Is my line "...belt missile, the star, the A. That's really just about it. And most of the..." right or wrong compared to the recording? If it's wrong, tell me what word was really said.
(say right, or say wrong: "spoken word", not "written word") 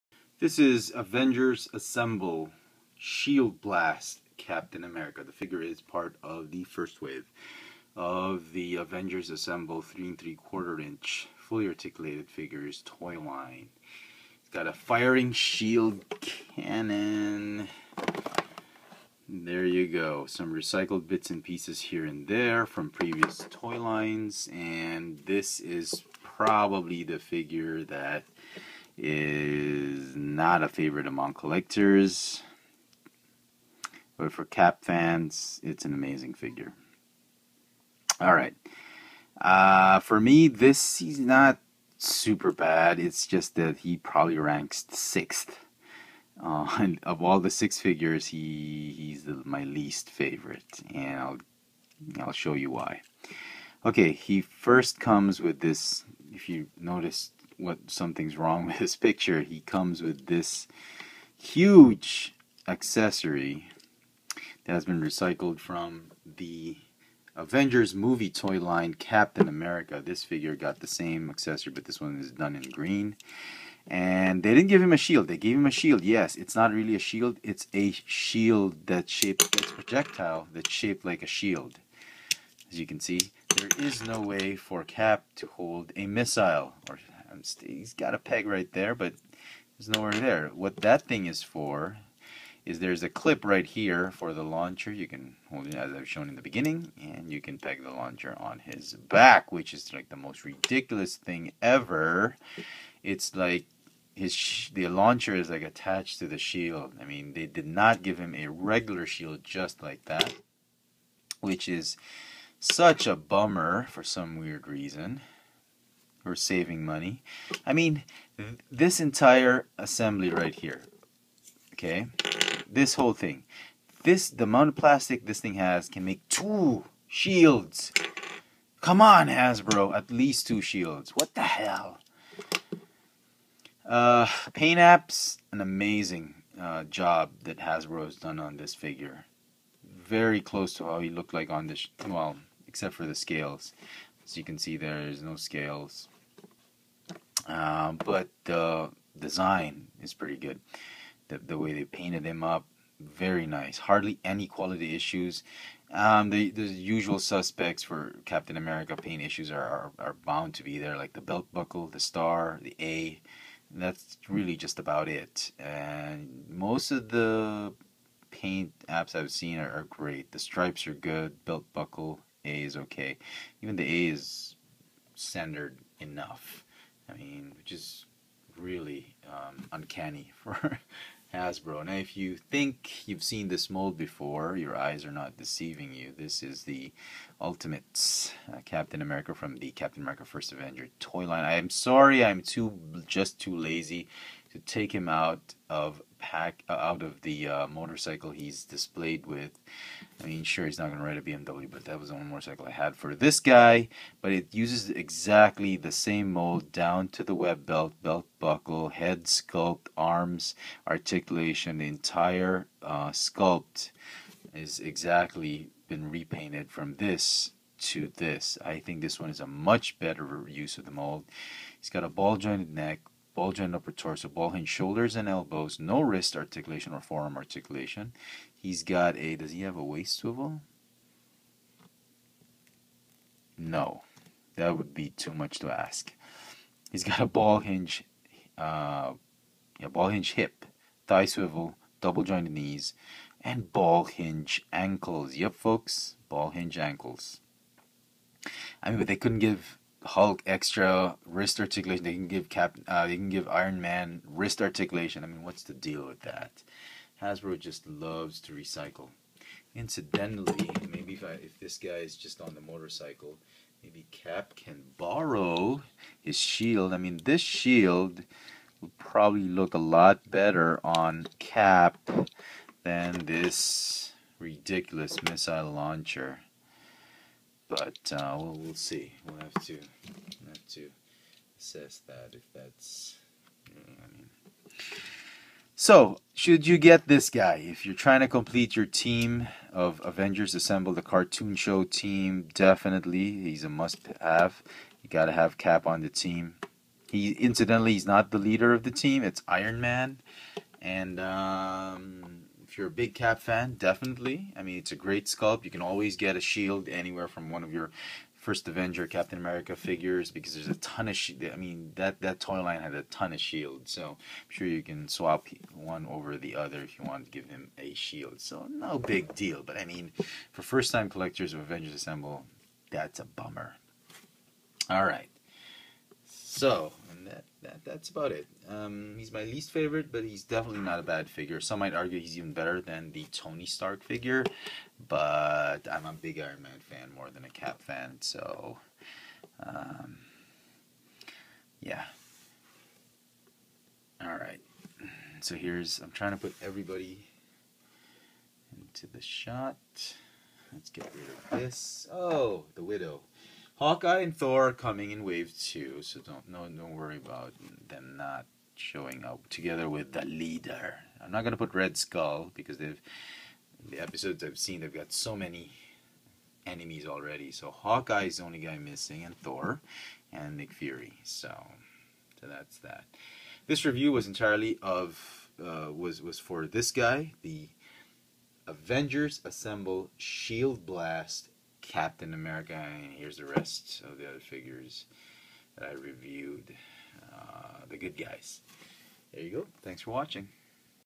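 wrong: "buckle", not "missile".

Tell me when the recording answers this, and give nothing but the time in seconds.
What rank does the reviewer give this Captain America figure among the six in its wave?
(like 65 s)
44 s.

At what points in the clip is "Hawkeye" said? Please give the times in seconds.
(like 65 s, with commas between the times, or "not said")
353 s, 367 s.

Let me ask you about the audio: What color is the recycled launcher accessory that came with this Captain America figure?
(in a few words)
green.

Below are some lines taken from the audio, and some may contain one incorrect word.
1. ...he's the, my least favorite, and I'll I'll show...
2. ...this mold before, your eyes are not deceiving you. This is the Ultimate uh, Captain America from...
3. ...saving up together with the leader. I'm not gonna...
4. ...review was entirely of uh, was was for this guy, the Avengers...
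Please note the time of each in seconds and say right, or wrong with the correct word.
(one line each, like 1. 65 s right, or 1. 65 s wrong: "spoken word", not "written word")
1. 48 s right
2. 183 s right
3. 358 s wrong: "showing", not "saving"
4. 373 s right.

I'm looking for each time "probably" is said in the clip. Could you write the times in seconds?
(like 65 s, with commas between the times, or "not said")
26 s, 43 s, 268 s.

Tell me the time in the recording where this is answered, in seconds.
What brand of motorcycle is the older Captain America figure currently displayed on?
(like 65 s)
201 s.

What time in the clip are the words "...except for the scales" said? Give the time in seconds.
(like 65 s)
142 s.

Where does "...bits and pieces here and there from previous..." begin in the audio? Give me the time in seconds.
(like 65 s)
21 s.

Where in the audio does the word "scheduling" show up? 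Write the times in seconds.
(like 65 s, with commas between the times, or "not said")
not said.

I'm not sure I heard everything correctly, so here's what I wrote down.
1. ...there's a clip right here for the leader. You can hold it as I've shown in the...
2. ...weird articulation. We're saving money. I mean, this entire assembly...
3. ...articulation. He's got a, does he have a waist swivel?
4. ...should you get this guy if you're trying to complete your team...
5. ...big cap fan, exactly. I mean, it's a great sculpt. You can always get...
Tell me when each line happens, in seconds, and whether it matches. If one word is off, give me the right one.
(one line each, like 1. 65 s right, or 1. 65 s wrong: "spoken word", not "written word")
1. 92 s wrong: "launcher", not "leader"
2. 114 s wrong: "reason", not "articulation"
3. 227 s right
4. 286 s right
5. 302 s wrong: "definitely", not "exactly".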